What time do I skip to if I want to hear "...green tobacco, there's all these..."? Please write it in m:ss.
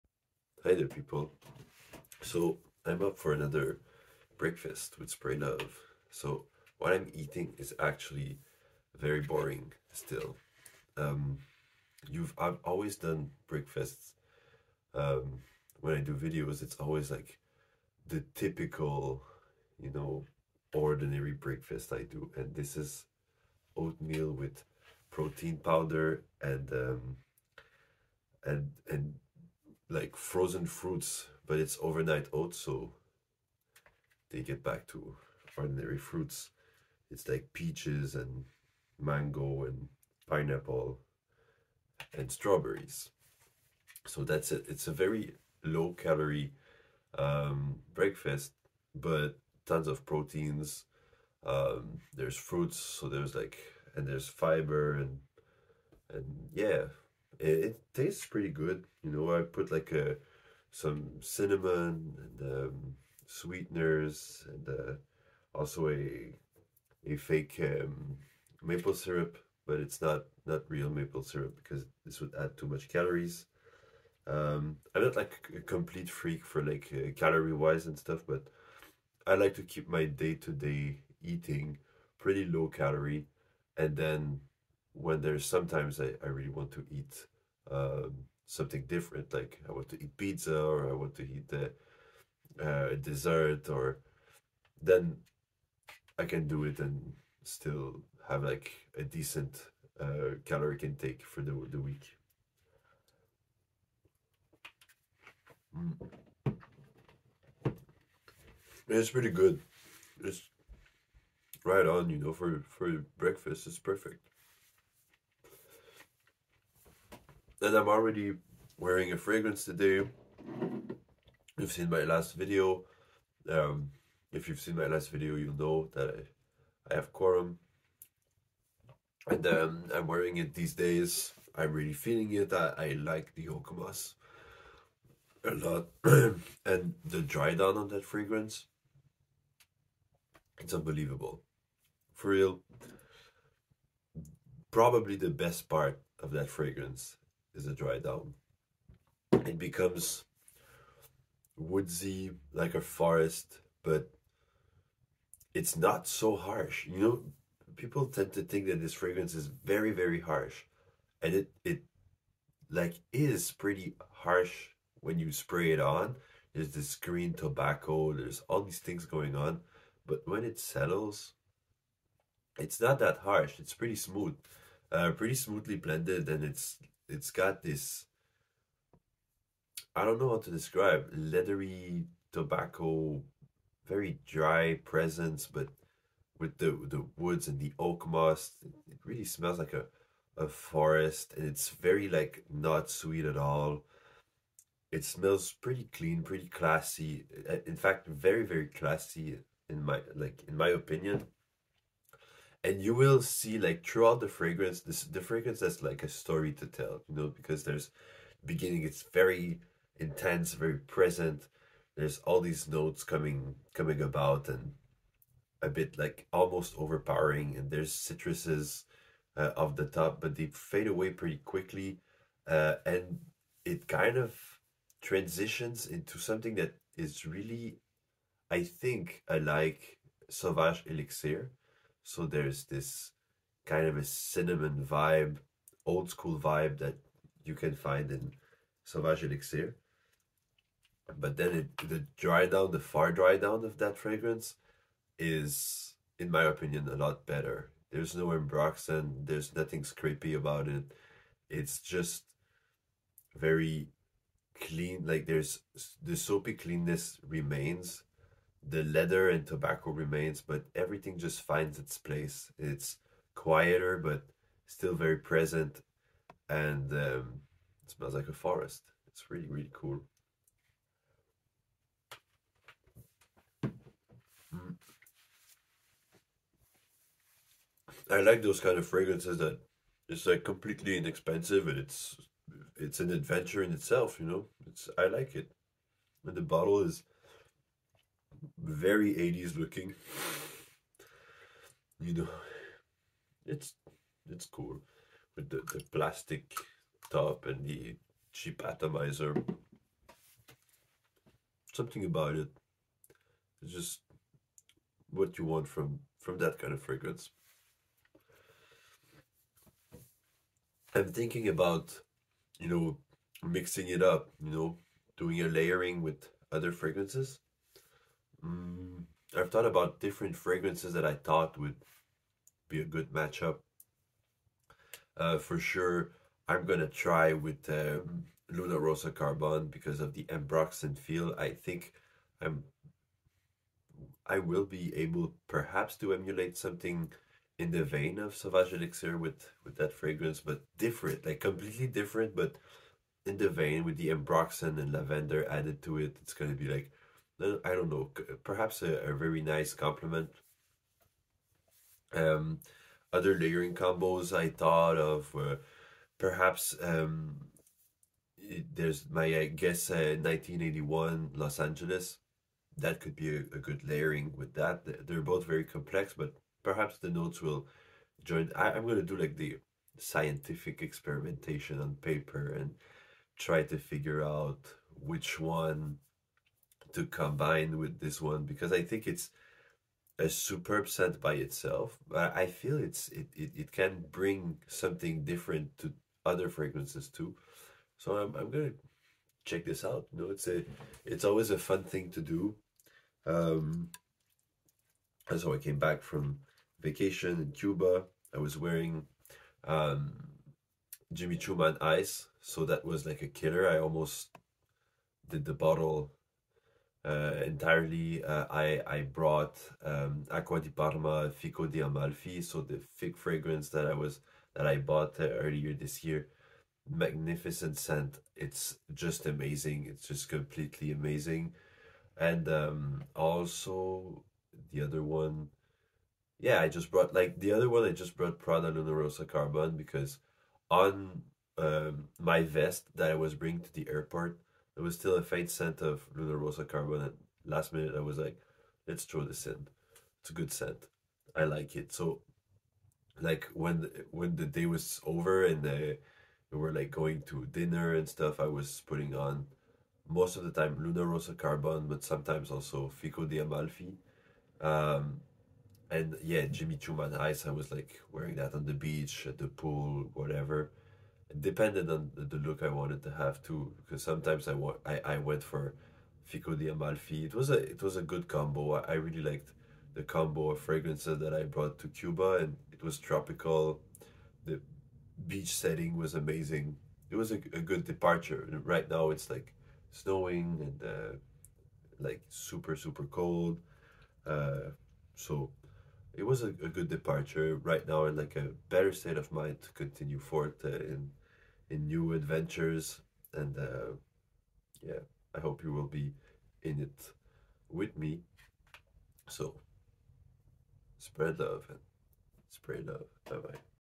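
2:46.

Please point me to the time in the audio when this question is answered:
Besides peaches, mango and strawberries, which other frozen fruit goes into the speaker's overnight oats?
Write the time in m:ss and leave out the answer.
0:40.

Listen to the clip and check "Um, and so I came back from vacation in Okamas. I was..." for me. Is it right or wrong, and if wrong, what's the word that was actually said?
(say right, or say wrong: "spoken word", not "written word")
wrong: "Cuba", not "Okamas".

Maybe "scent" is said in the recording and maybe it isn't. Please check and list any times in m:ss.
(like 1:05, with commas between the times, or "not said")
6:57, 7:15, 7:20.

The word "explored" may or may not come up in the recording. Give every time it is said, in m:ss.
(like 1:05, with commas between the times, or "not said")
not said.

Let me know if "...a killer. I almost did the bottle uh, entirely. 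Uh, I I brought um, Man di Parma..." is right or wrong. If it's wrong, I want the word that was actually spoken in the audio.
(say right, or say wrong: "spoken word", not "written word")
wrong: "Acqua", not "Man".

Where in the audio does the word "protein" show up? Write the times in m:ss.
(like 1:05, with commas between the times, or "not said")
0:25, 0:50.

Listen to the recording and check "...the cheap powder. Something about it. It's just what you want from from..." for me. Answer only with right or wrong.
wrong.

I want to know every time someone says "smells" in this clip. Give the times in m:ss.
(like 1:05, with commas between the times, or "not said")
3:09, 3:15, 4:27.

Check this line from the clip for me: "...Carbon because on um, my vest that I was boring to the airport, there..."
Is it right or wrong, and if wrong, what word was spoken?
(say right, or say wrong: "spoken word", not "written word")
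wrong: "bringing", not "boring".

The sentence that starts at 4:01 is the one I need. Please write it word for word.
But then it, the dry down, the far dry down of that fragrance is, in my opinion, a lot better.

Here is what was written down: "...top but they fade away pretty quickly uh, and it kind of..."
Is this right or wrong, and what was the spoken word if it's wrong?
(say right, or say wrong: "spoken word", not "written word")
right.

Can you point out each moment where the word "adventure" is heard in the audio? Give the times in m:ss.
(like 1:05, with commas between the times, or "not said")
4:43, 8:12.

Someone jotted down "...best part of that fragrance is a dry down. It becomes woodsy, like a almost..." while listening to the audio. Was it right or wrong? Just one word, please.
wrong.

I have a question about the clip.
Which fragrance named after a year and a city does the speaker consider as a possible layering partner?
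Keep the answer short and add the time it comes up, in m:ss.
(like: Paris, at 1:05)
1981 Los Angeles, at 6:00.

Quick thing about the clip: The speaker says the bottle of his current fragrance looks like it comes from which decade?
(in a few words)
The 80s.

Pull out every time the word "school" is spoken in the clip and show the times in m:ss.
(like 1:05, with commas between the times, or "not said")
3:56.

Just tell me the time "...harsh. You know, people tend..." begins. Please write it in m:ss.
2:36.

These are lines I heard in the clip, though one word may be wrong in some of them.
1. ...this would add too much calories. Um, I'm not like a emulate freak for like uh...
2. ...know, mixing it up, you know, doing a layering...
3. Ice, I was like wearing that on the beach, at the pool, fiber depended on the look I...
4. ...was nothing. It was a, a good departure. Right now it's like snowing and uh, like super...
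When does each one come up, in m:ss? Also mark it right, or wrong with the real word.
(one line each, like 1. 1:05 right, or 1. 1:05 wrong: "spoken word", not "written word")
1. 1:12 wrong: "complete", not "emulate"
2. 5:12 right
3. 7:37 wrong: "whatever", not "fiber"
4. 7:55 wrong: "amazing", not "nothing".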